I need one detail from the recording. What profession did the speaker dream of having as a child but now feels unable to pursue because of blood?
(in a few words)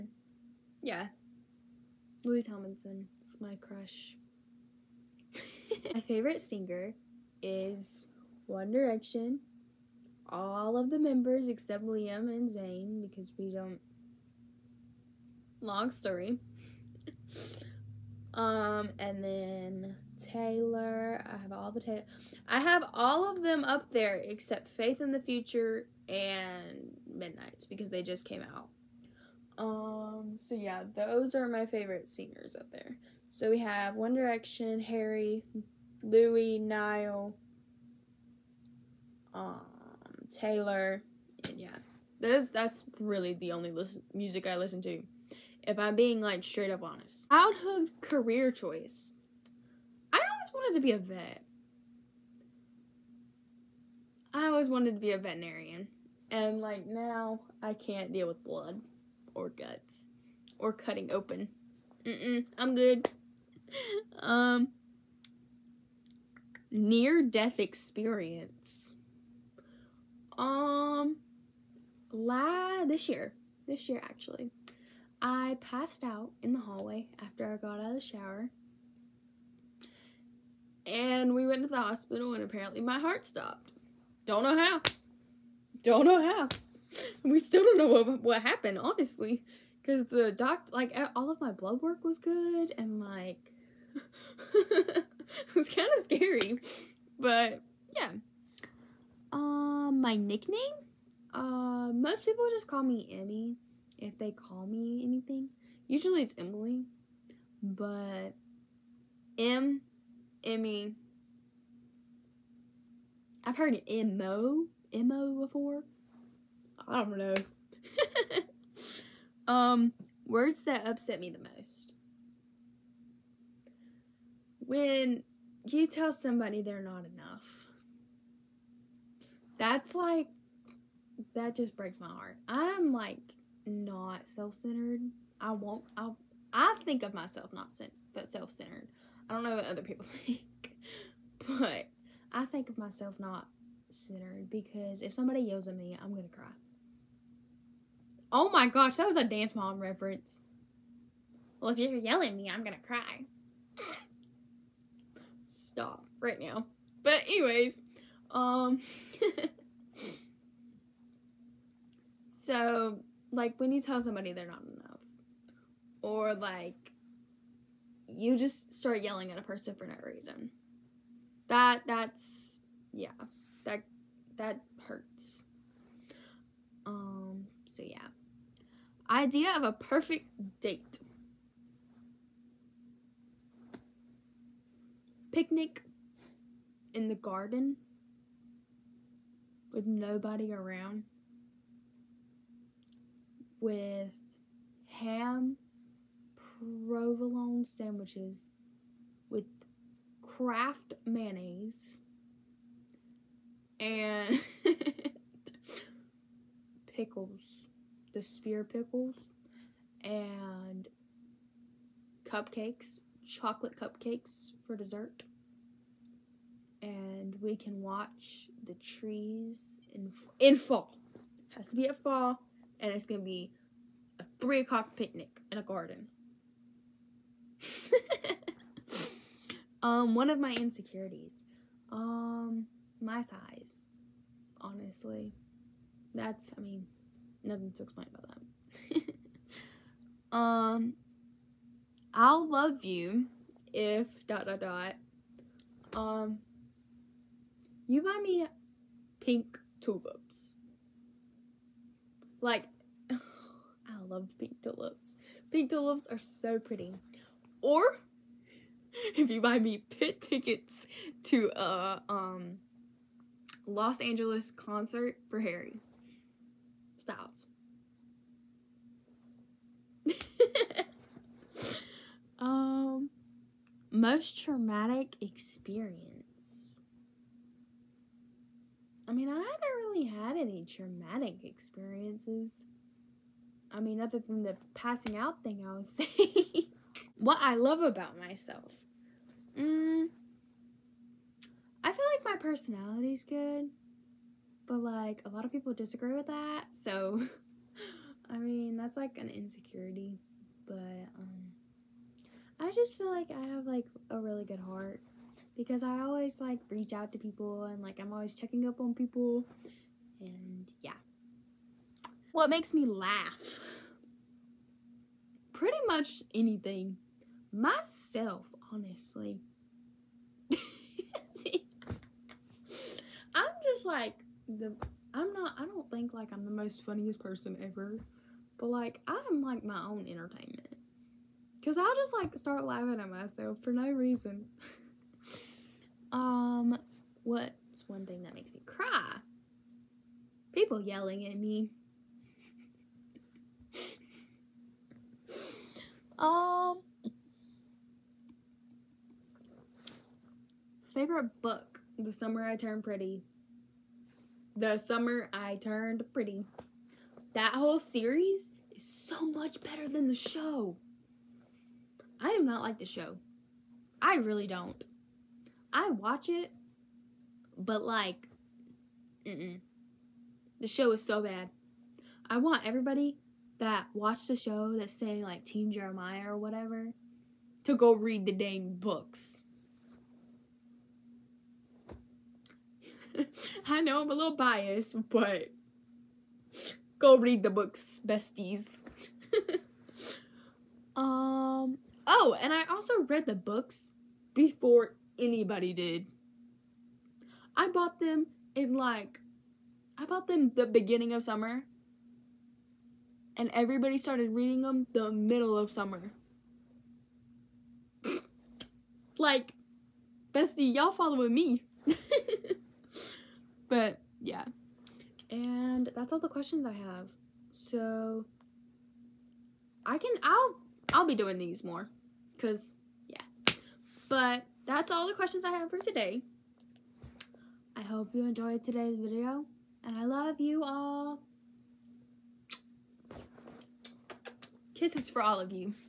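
Veterinarian.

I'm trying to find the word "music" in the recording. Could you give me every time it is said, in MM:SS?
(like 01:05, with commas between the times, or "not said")
00:44.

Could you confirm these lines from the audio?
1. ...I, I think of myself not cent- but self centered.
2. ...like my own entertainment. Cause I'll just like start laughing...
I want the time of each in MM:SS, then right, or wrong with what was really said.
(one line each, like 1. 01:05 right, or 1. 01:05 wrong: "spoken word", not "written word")
1. 02:15 right
2. 05:29 right.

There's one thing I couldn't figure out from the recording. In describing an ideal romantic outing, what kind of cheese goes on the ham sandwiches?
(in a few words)
Provolone.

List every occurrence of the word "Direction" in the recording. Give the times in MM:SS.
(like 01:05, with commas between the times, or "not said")
00:08, 00:34.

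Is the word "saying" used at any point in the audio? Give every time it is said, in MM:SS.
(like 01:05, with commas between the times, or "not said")
04:45, 06:14.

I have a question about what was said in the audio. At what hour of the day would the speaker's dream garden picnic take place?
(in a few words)
3 o'clock.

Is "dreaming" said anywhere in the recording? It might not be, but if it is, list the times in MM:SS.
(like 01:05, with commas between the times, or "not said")
not said.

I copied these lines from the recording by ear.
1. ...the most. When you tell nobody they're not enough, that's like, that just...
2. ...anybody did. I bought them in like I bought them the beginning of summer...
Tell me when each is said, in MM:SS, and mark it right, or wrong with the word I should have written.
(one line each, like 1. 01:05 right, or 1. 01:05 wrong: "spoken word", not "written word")
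1. 02:01 wrong: "somebody", not "nobody"
2. 06:35 right.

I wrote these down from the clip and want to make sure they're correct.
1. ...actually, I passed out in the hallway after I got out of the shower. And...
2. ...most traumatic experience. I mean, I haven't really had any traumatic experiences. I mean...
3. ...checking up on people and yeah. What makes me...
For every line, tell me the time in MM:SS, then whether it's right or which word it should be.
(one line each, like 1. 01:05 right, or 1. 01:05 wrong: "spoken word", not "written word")
1. 01:14 right
2. 04:33 right
3. 05:08 right.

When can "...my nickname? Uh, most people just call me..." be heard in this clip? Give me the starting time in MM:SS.
01:39.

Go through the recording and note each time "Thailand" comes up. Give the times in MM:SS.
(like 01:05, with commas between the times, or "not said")
not said.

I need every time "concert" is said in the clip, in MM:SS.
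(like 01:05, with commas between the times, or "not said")
04:24.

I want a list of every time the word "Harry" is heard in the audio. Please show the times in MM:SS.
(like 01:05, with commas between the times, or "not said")
00:34, 04:25.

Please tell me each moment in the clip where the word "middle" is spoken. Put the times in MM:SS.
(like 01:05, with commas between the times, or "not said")
06:45.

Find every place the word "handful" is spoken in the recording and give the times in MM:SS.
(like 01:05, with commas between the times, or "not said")
not said.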